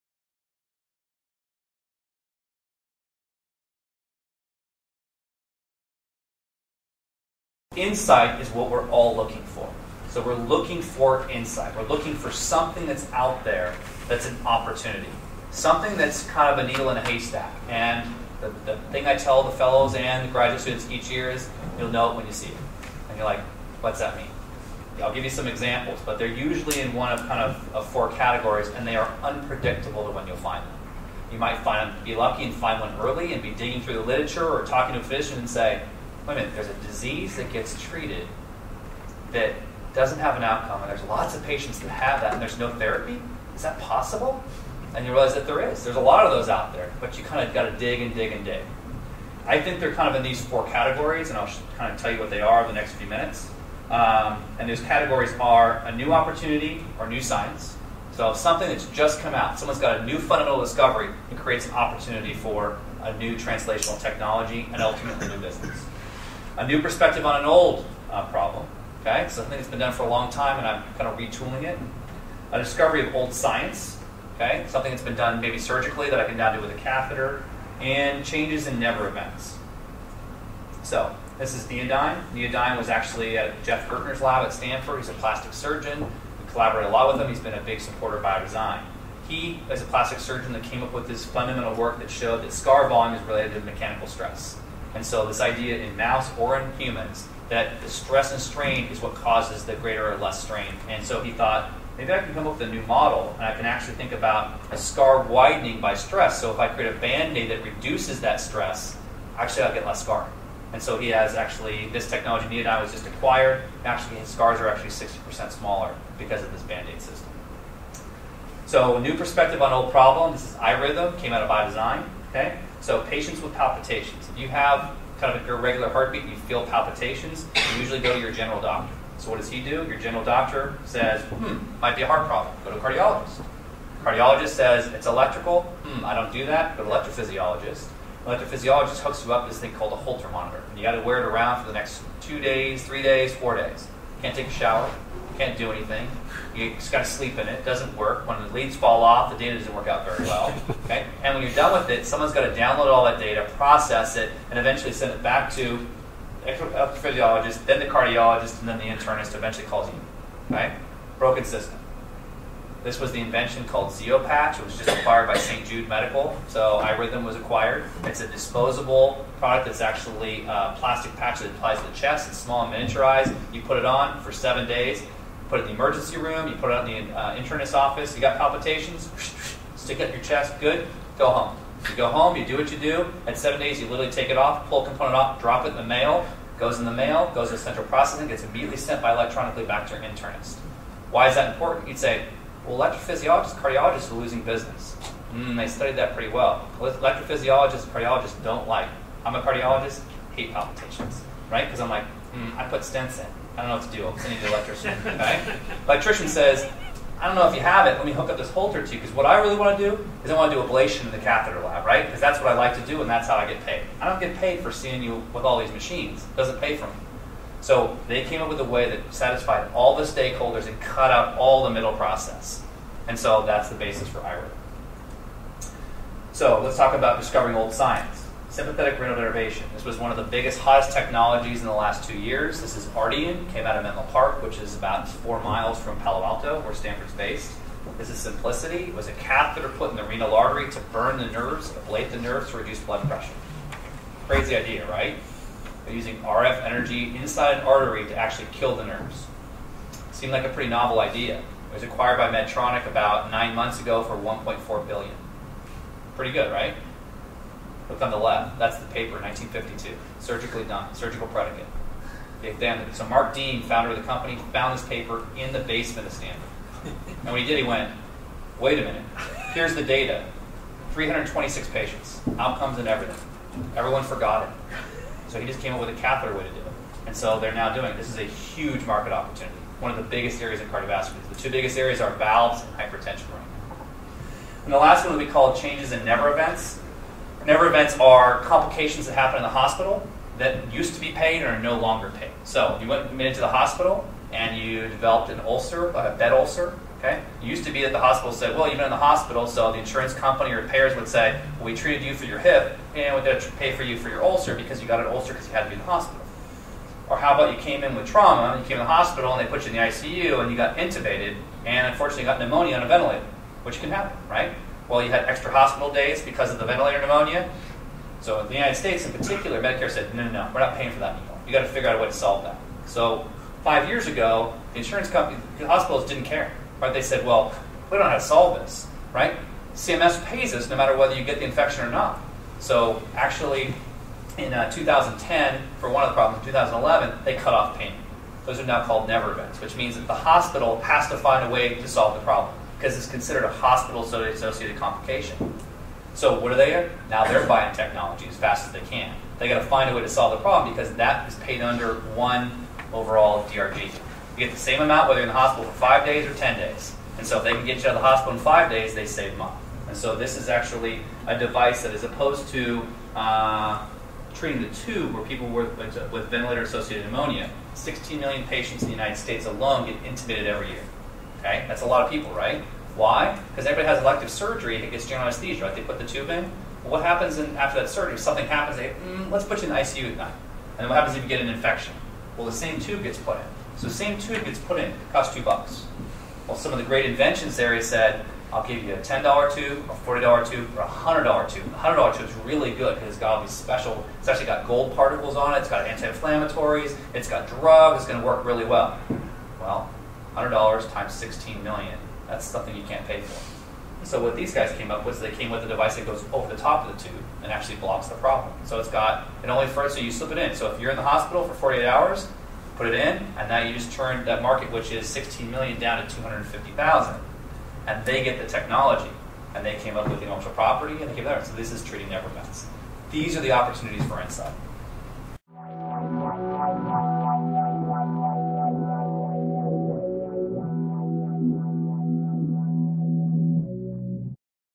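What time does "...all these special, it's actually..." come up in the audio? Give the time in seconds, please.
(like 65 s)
393 s.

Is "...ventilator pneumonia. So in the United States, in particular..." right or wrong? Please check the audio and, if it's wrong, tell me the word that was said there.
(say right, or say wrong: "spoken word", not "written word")
right.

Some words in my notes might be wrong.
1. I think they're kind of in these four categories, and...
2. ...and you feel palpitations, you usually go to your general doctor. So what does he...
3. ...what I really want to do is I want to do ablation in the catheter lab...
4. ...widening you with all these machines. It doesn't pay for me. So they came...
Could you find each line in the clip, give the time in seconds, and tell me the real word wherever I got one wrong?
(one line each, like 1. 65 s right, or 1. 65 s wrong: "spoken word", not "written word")
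1. 49 s right
2. 126 s right
3. 209 s right
4. 214 s wrong: "seeing", not "widening".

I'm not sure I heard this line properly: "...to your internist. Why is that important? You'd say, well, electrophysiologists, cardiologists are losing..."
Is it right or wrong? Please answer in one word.
right.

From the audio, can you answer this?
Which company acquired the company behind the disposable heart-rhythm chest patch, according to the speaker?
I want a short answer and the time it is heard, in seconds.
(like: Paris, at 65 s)
St. Jude Medical, at 165 s.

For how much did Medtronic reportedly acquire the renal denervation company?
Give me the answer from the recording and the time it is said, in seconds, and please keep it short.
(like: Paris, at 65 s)
1.4 billion, at 254 s.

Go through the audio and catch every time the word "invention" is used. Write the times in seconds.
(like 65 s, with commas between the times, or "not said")
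163 s, 387 s.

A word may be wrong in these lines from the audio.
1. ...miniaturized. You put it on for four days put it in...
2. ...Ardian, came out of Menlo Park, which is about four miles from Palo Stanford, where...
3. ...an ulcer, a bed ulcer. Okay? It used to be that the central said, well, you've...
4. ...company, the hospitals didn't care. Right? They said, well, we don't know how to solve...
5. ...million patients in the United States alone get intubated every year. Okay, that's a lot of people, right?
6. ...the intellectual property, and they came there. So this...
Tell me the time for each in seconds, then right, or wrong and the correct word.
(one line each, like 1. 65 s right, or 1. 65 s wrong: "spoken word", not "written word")
1. 172 s wrong: "seven", not "four"
2. 232 s wrong: "Alto", not "Stanford"
3. 295 s wrong: "hospital", not "central"
4. 325 s right
5. 368 s right
6. 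420 s right.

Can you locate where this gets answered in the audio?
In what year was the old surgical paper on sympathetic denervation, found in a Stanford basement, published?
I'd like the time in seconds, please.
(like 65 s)
259 s.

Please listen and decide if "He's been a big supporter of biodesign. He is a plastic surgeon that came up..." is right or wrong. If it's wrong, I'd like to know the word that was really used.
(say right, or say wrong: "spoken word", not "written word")
right.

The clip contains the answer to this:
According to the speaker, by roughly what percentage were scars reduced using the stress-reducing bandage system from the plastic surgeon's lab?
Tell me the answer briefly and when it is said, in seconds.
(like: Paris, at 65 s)
60%, at 114 s.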